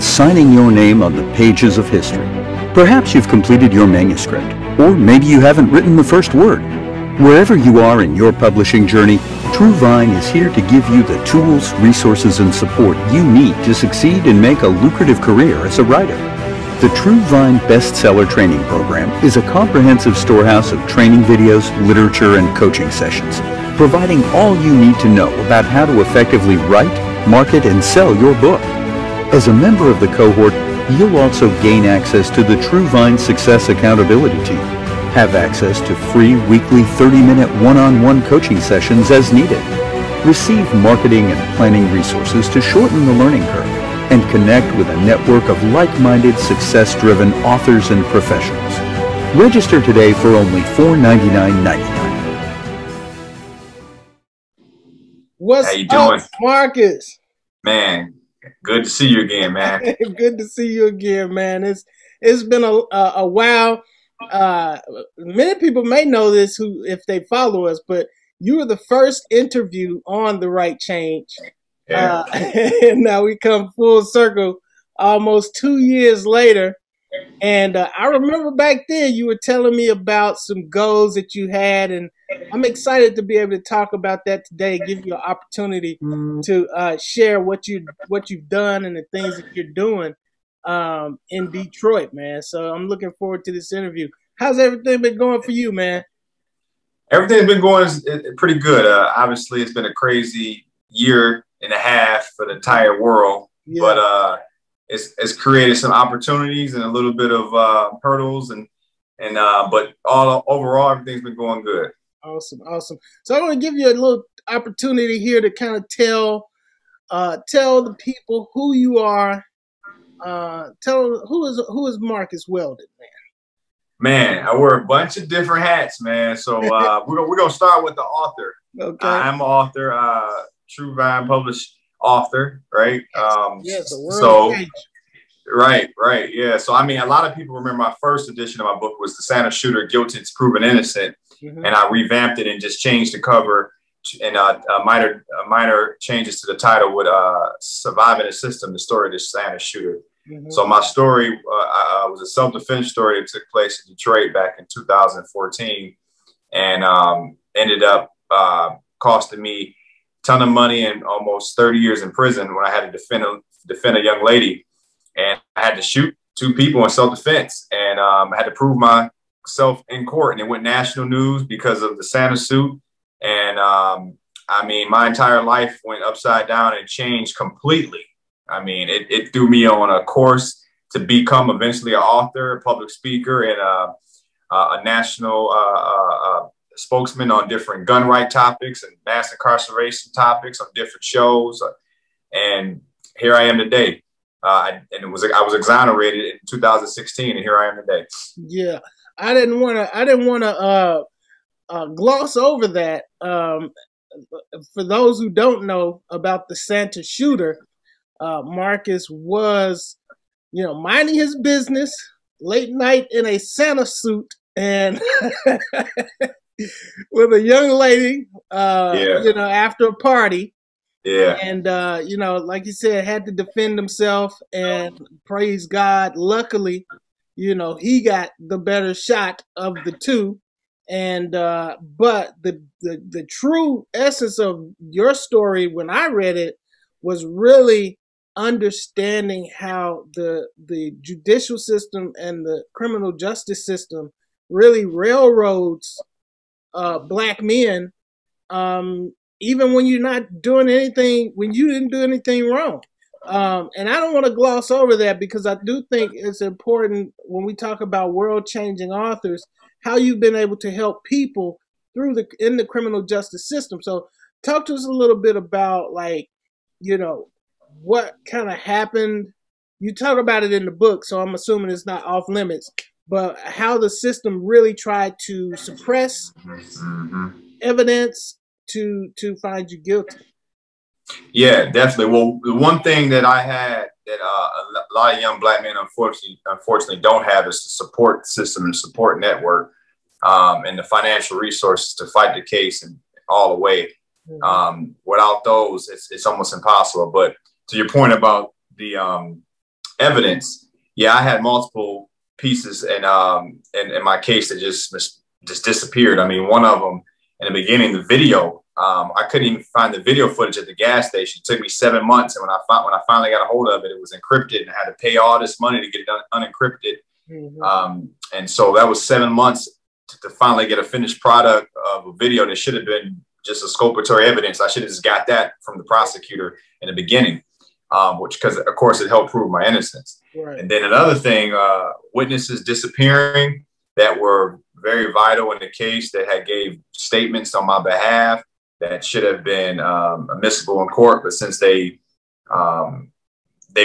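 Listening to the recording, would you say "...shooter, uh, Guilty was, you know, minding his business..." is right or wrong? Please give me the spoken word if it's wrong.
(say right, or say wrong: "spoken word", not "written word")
wrong: "Marcus", not "Guilty".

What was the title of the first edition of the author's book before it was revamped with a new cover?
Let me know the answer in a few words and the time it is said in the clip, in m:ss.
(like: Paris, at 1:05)
The Santa Shooter: Guilty It's Proven Innocent, at 2:19.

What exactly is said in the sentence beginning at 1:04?
Uh, many people may know this who if they follow us, but you were the first interview on the Write Change.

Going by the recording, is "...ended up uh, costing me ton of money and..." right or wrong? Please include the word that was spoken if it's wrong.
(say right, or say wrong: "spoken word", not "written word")
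right.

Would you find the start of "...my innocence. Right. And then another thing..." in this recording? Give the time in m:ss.
5:29.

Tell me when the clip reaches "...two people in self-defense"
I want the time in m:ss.
2:46.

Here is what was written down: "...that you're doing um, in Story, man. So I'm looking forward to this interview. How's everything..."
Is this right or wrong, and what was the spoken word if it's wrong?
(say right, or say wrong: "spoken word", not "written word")
wrong: "Detroit", not "Story".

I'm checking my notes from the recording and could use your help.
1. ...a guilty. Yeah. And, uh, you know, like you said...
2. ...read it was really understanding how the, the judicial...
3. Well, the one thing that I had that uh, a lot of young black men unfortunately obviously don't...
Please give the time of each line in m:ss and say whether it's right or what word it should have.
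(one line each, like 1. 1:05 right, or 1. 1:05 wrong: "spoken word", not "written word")
1. 3:39 wrong: "party", not "guilty"
2. 3:56 right
3. 4:42 wrong: "unfortunately", not "obviously".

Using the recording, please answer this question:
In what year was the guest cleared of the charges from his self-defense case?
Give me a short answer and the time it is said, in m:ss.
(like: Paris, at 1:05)
2016, at 3:16.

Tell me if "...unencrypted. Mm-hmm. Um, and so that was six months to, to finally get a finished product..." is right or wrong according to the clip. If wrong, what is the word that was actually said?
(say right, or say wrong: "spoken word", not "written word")
wrong: "seven", not "six".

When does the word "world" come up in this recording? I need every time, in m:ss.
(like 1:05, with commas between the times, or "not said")
1:43, 2:13, 4:18.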